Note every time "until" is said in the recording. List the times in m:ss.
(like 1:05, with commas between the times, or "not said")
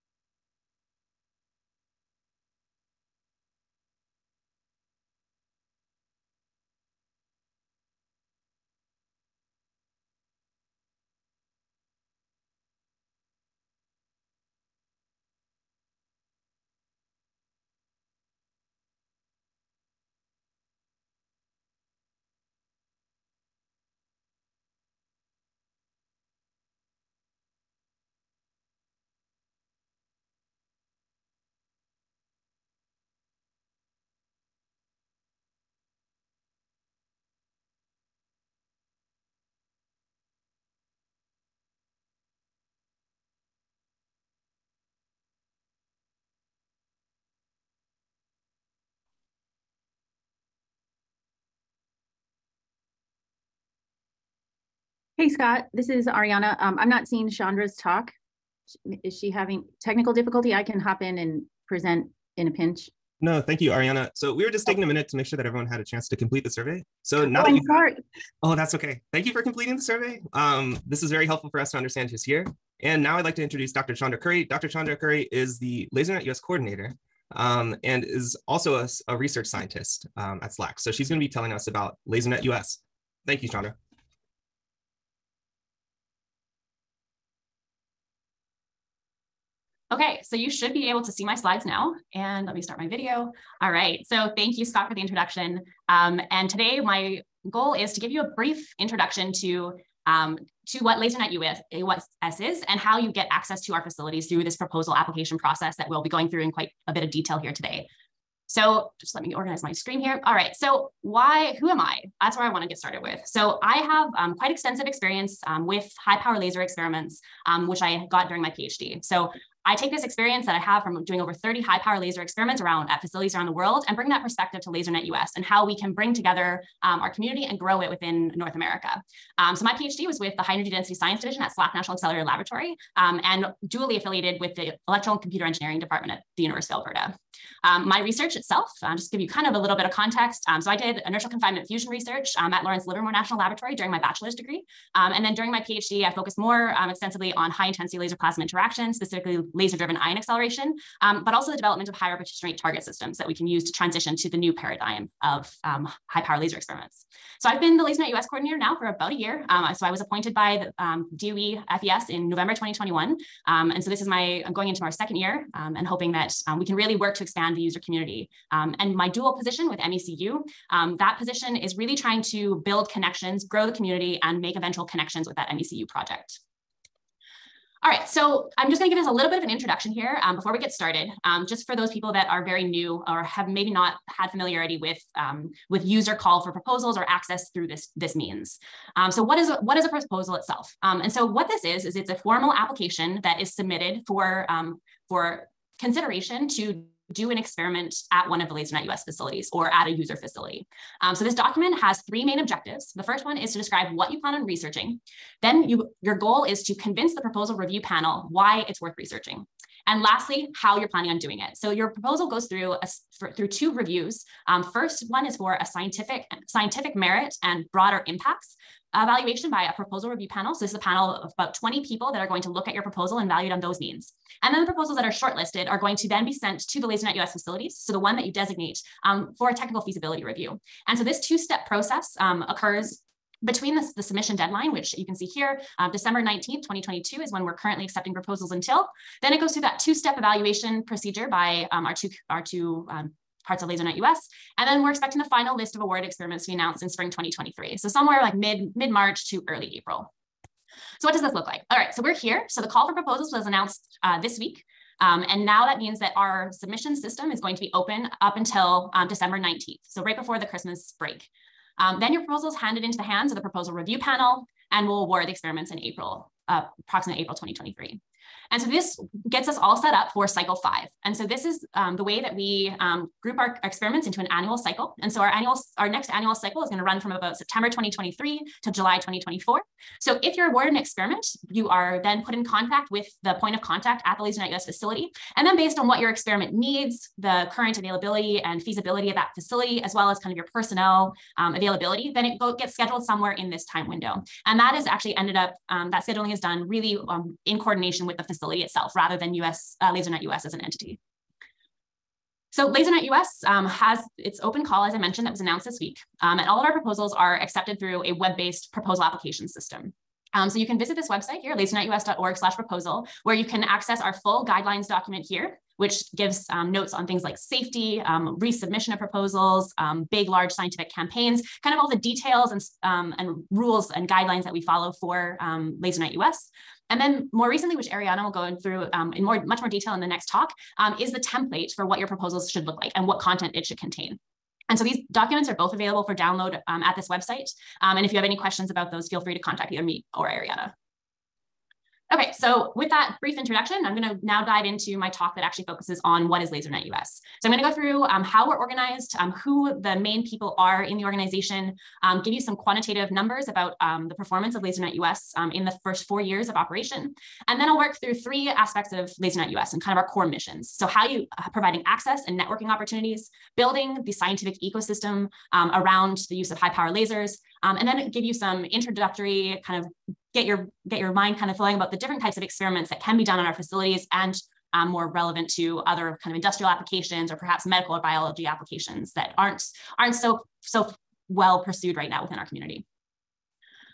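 3:58, 4:18.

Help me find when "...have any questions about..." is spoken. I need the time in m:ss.
5:38.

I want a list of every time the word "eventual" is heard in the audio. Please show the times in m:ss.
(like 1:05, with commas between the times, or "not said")
2:54.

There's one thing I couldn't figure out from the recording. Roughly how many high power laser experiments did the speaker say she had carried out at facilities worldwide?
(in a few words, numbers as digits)
over 30.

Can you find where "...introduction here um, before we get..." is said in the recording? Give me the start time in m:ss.
2:59.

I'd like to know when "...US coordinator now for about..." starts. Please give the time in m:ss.
2:38.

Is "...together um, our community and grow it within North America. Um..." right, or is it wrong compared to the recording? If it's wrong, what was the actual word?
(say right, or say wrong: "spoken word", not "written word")
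right.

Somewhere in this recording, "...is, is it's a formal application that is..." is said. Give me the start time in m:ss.
3:11.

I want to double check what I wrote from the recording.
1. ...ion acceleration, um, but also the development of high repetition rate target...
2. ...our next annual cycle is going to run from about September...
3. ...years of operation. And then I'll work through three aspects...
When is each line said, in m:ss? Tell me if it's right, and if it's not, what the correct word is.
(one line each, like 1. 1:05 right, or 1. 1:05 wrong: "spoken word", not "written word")
1. 2:29 right
2. 4:35 right
3. 5:56 right.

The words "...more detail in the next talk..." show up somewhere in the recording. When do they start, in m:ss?
5:29.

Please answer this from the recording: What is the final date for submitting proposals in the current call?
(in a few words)
December 19th, 2022.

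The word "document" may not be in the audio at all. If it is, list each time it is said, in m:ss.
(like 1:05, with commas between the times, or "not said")
3:21, 5:14, 5:35.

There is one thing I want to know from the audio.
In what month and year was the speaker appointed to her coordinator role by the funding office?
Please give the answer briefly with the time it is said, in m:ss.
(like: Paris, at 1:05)
November 2021, at 2:42.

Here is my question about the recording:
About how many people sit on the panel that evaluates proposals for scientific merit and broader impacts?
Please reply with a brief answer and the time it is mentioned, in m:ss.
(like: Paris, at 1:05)
20, at 3:41.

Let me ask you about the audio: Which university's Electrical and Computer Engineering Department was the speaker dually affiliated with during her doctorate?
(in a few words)
University of Alberta.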